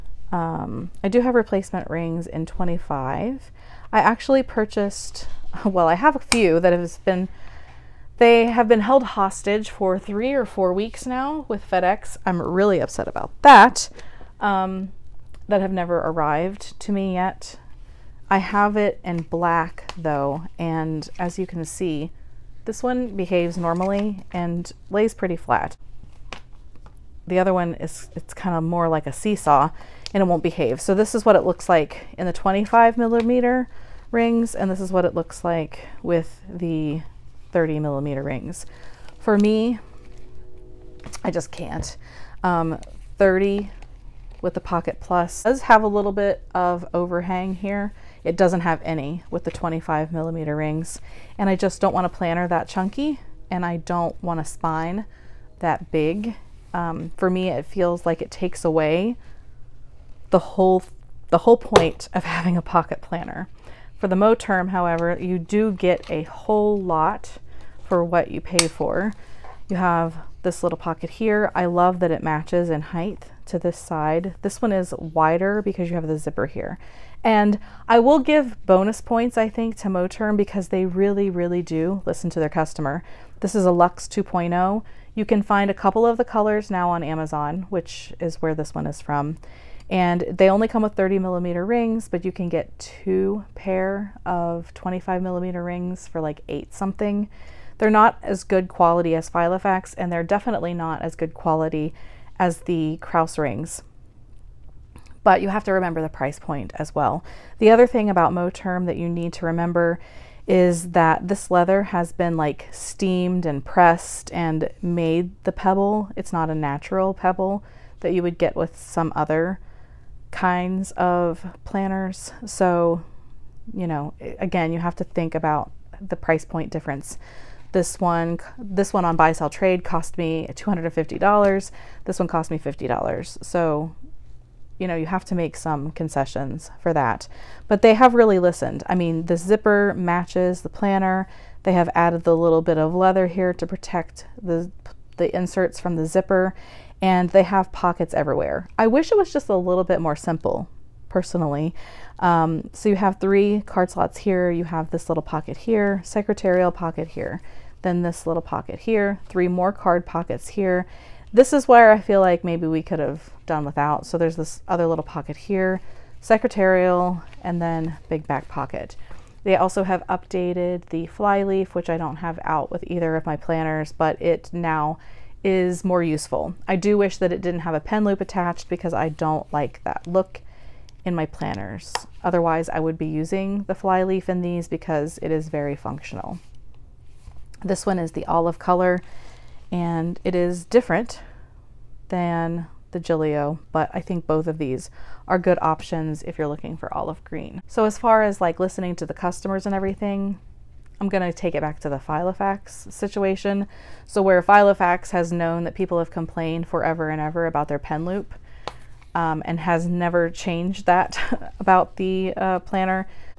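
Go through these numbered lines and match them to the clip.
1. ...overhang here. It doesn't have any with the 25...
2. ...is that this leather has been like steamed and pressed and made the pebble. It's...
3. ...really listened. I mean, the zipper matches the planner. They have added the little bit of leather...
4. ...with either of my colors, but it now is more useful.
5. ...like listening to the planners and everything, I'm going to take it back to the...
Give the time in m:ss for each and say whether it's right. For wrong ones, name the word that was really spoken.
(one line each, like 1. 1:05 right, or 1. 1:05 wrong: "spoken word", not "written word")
1. 0:46 right
2. 1:50 right
3. 2:18 right
4. 2:52 wrong: "planners", not "colors"
5. 3:18 wrong: "customers", not "planners".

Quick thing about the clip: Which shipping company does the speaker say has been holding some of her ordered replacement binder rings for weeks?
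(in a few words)
FedEx.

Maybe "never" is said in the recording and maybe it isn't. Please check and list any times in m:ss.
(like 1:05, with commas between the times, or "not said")
0:15, 3:29.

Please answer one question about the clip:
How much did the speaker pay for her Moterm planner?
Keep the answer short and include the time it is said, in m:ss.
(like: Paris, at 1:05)
$50, at 2:12.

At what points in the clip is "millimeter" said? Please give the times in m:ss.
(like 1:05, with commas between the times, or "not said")
0:32, 0:37, 0:50, 1:31, 1:35.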